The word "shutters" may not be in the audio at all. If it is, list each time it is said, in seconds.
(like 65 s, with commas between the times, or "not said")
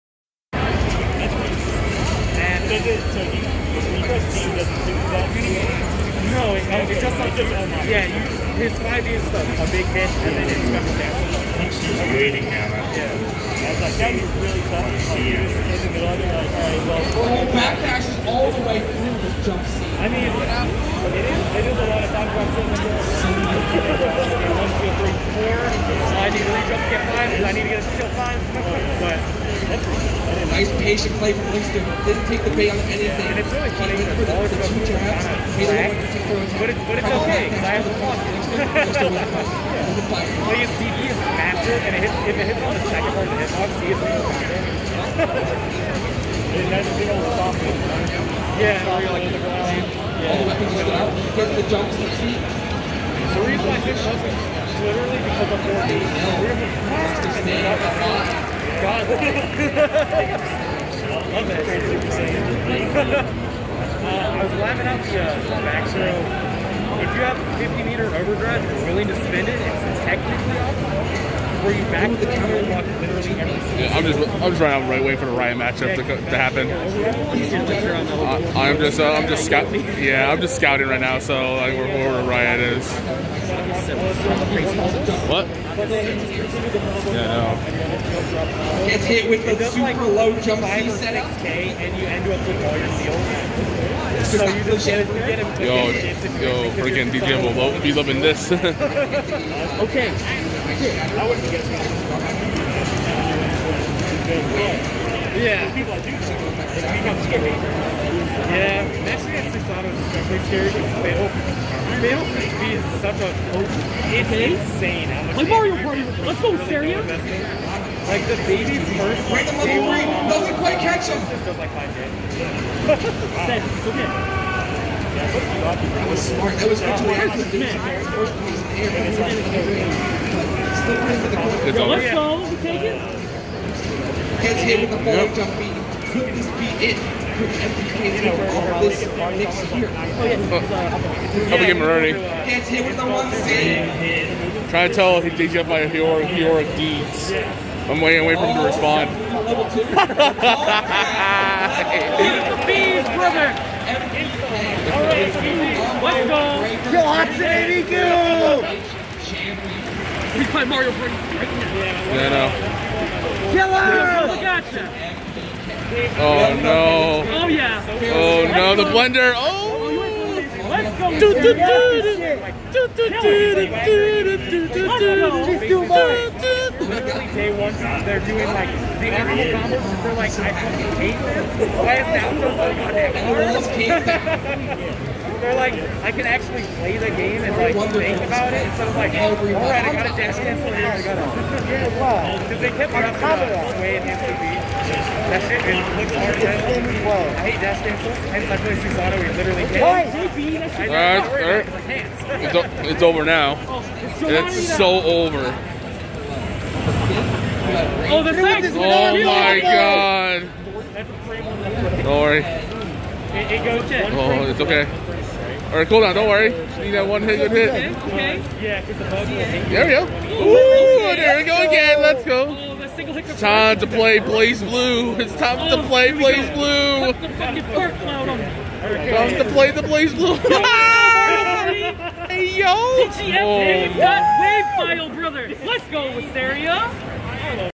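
not said.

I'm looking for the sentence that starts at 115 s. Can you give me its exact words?
How much like Mario Party, let's go, really Like the baby's first, like, level three doesn't quite catch him.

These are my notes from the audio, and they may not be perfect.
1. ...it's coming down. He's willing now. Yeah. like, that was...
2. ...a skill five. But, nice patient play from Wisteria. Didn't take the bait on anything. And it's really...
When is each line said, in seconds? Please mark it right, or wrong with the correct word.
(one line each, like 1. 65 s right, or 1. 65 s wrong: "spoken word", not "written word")
1. 10 s wrong: "waiting", not "willing"
2. 27 s wrong: "Winston", not "Wisteria".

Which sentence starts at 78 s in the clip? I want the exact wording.
I'm just uh, I'm just scout yeah I'm just scouting right now so like where, where riot is.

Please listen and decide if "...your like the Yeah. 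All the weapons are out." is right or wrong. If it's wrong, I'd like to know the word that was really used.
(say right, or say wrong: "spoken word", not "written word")
right.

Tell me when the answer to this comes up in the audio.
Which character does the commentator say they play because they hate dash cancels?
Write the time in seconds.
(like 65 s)
198 s.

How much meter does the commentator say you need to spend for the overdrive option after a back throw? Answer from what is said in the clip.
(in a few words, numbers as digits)
50.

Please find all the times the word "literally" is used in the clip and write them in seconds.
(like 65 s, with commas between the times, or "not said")
54 s, 72 s, 176 s, 199 s.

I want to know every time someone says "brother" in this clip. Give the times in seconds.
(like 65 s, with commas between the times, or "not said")
153 s, 235 s.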